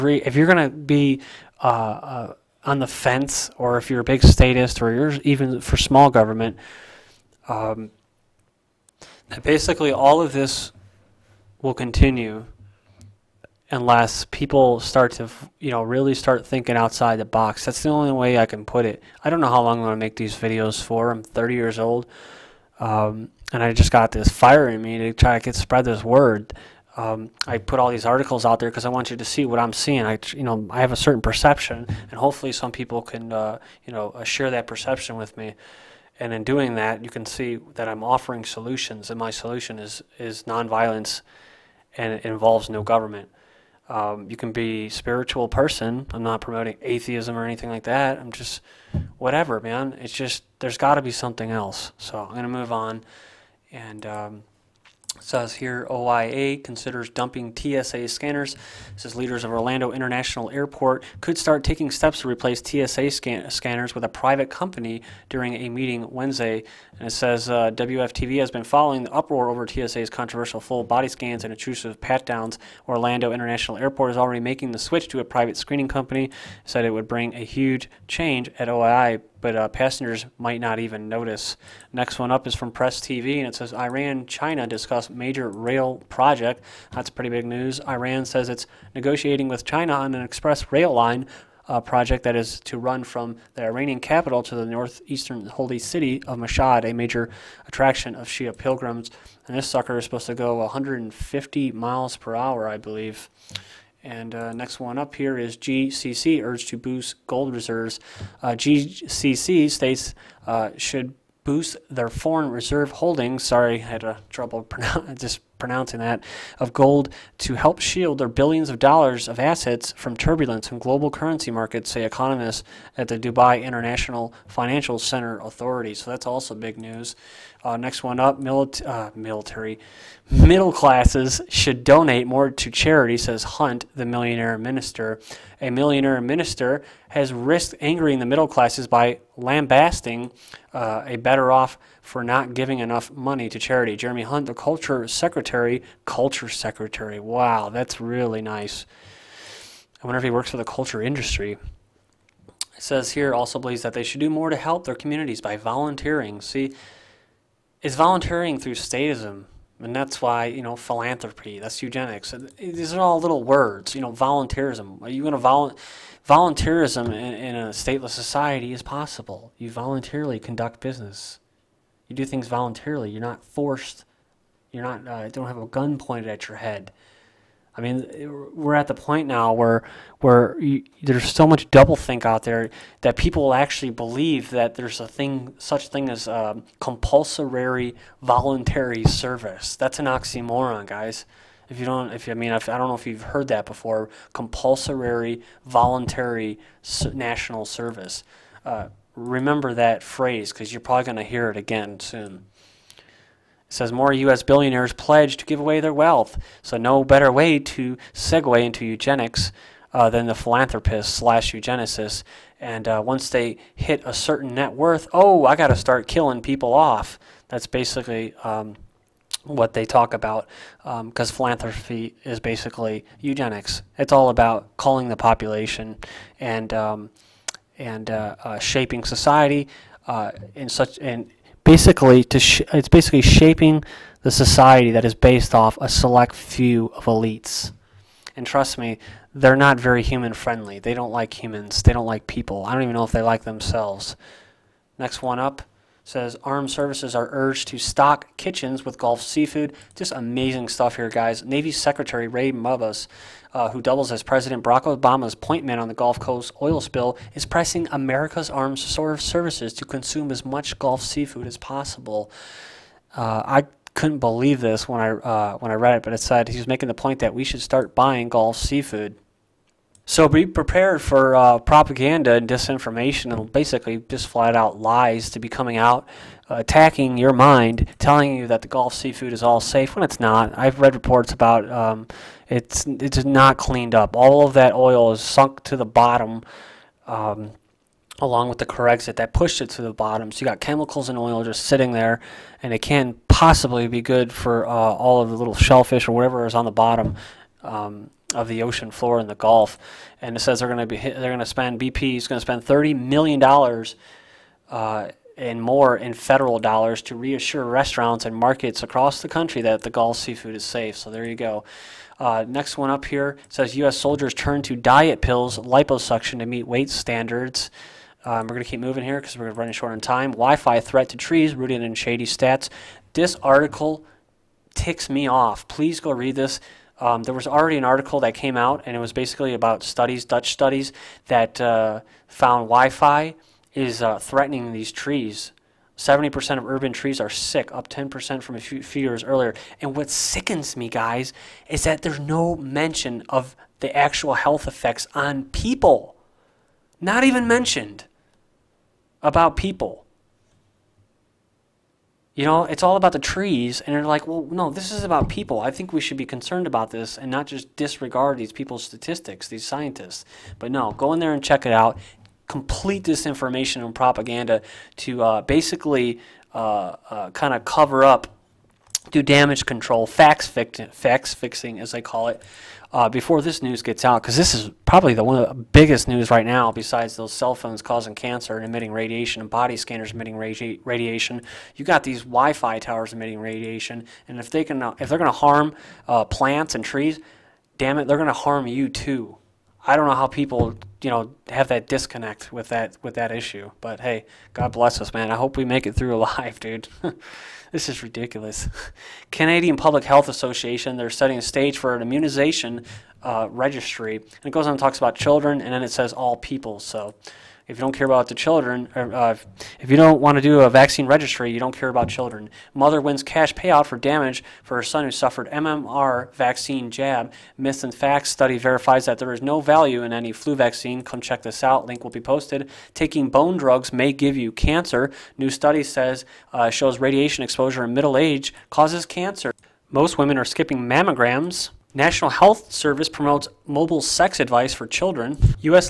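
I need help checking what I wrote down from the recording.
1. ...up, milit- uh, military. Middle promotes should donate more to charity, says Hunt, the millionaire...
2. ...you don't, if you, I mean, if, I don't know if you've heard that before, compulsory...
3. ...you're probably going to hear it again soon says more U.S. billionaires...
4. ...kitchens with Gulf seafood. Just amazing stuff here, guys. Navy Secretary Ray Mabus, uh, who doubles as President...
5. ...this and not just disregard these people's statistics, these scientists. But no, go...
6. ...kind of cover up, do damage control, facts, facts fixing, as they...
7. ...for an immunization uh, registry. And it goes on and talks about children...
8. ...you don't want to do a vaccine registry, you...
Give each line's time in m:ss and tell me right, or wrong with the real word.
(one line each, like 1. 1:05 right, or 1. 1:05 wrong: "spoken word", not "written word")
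1. 2:08 wrong: "classes", not "promotes"
2. 3:11 right
3. 3:20 right
4. 4:08 right
5. 5:56 right
6. 6:07 right
7. 6:41 right
8. 6:49 right.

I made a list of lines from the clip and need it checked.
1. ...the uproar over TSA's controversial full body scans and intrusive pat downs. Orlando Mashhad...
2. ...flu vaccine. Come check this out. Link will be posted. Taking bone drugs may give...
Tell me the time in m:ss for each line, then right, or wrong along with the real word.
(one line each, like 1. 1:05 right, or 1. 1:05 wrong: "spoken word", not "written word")
1. 1:09 wrong: "International", not "Mashhad"
2. 7:00 right.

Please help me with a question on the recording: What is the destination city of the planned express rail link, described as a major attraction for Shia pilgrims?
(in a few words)
Mashhad.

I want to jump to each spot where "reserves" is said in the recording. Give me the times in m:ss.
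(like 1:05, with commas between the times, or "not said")
1:47, 1:52.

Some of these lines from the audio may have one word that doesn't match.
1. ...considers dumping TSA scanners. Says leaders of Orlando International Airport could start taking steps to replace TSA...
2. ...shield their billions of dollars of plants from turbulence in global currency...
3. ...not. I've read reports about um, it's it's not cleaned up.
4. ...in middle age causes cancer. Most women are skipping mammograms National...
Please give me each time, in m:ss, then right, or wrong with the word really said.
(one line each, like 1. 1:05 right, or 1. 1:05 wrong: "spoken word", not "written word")
1. 0:56 right
2. 1:57 wrong: "assets", not "plants"
3. 4:40 right
4. 7:07 right.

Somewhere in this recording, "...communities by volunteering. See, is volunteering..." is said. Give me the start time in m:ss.
2:34.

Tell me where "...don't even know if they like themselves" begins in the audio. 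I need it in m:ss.
4:02.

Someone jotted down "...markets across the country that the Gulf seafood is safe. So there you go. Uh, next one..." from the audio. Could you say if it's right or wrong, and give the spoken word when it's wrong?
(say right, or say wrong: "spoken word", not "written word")
right.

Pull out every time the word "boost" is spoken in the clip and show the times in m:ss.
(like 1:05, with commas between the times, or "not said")
1:46, 1:51.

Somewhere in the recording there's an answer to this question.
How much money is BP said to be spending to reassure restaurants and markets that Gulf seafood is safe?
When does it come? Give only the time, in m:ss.
5:02.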